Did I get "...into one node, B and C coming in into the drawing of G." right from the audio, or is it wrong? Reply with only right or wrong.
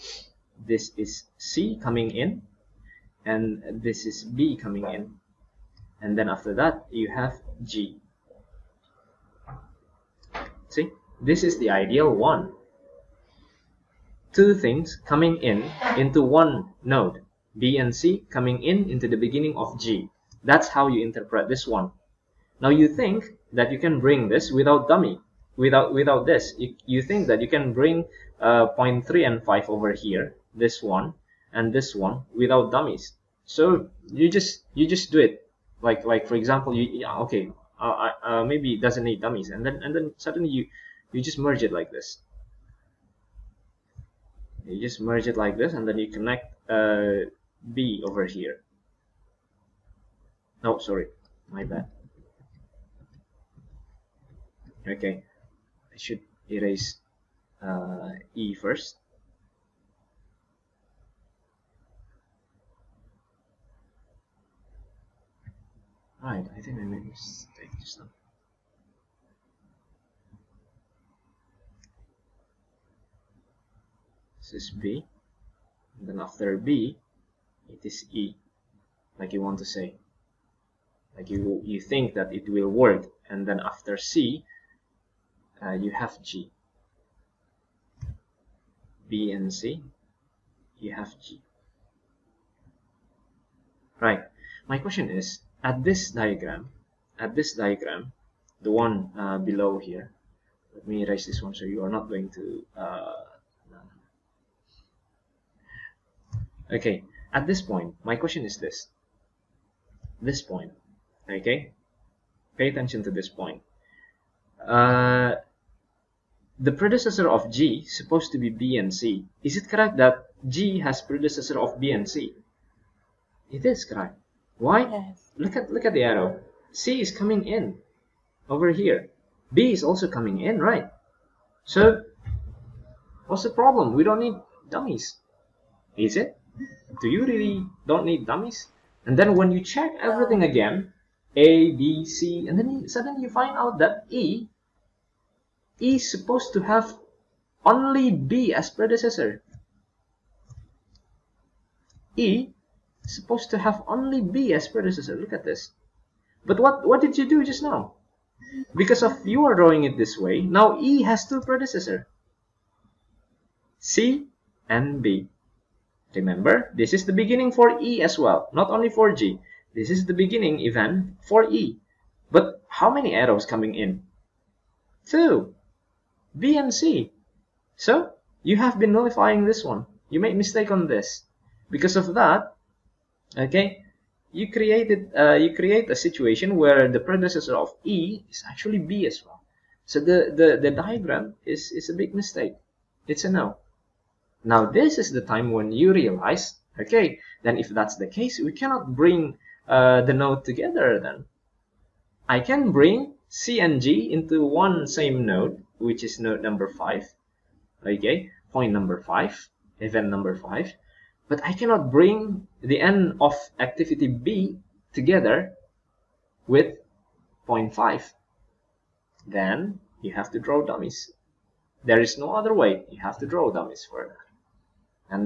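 wrong.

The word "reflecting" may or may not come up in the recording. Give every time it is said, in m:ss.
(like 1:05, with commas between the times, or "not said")
not said.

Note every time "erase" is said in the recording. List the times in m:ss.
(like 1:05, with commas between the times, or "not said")
0:56, 1:41.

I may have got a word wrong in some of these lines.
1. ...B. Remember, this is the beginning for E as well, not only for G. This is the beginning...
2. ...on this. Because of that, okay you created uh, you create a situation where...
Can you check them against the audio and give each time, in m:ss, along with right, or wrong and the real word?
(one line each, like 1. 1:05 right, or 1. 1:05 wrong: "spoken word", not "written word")
1. 2:45 right
2. 3:00 right.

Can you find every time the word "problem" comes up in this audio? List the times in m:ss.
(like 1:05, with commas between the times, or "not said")
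2:13.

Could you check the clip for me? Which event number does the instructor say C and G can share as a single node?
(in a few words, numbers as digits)
5.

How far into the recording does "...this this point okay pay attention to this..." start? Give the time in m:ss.
1:48.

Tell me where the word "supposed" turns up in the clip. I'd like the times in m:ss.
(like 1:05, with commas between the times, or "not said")
1:57, 2:26, 2:33.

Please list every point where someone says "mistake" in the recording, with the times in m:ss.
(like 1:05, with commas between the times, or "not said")
1:07, 3:00, 3:12.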